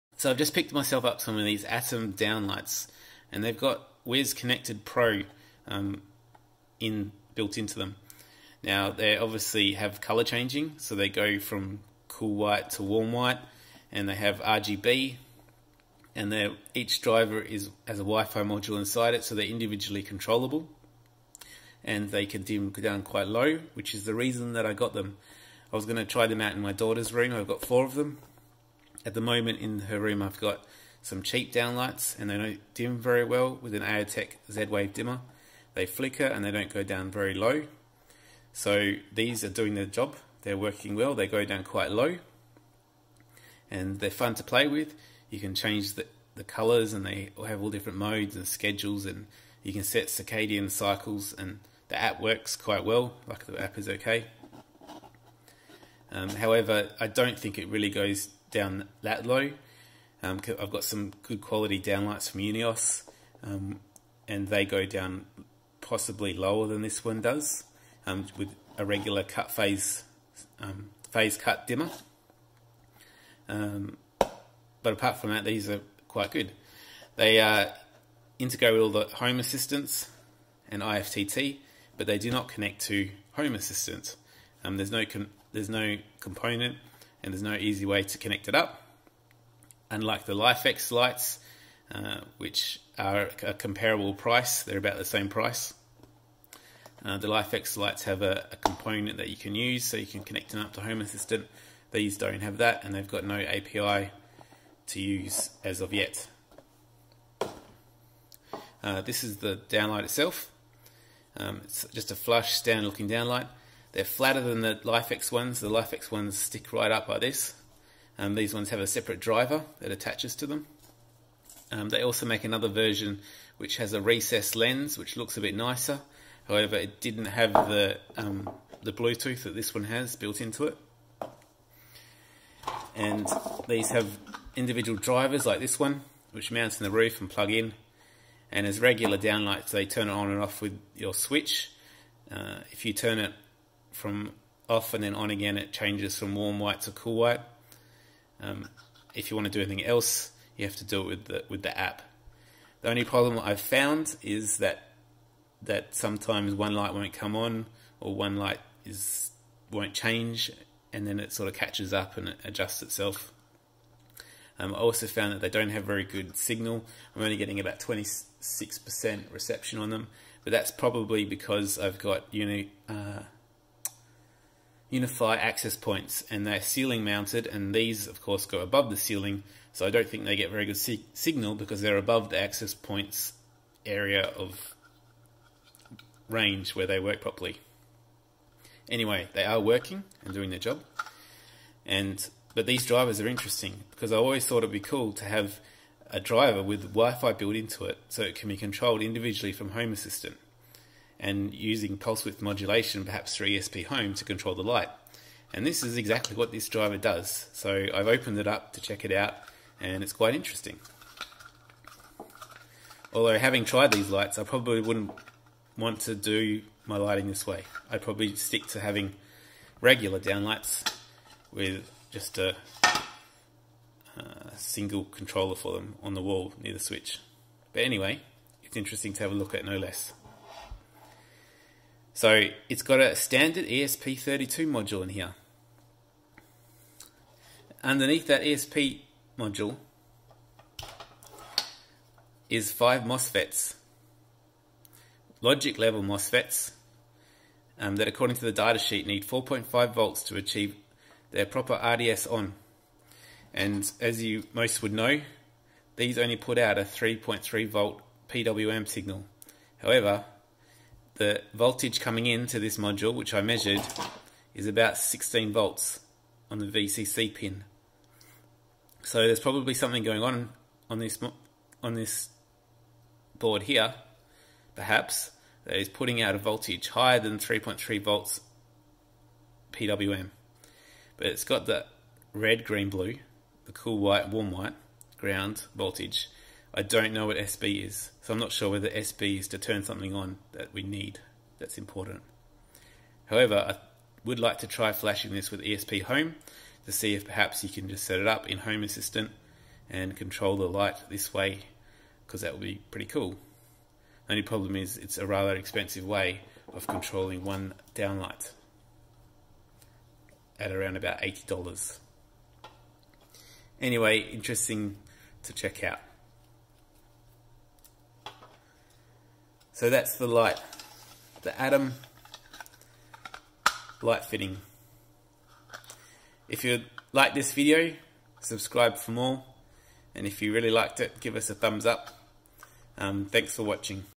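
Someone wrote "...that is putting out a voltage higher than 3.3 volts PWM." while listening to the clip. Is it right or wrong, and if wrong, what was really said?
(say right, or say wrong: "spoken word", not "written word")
right.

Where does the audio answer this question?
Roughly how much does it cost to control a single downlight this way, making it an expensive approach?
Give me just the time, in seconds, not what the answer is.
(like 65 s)
311 s.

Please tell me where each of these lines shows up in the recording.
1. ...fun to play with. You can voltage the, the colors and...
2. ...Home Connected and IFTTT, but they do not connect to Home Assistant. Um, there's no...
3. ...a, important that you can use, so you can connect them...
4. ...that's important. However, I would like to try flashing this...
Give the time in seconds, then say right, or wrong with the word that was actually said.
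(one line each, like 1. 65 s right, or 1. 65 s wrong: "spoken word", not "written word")
1. 44 s wrong: "change", not "voltage"
2. 79 s wrong: "Assistance", not "Connected"
3. 98 s wrong: "component", not "important"
4. 291 s right.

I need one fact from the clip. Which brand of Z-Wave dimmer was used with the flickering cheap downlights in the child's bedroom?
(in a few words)
Aeotec.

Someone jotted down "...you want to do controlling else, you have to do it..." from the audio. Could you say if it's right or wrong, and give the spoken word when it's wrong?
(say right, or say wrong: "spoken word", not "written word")
wrong: "anything", not "controlling".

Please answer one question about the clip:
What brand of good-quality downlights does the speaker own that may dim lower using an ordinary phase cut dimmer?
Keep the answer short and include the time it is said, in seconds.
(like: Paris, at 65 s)
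Unios, at 62 s.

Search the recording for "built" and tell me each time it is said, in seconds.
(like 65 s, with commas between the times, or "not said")
7 s, 130 s, 197 s.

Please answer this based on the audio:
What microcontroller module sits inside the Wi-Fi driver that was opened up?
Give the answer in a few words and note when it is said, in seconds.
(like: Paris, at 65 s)
ESP32, at 233 s.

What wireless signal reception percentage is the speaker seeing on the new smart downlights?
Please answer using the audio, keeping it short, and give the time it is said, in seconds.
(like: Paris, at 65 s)
26%, at 167 s.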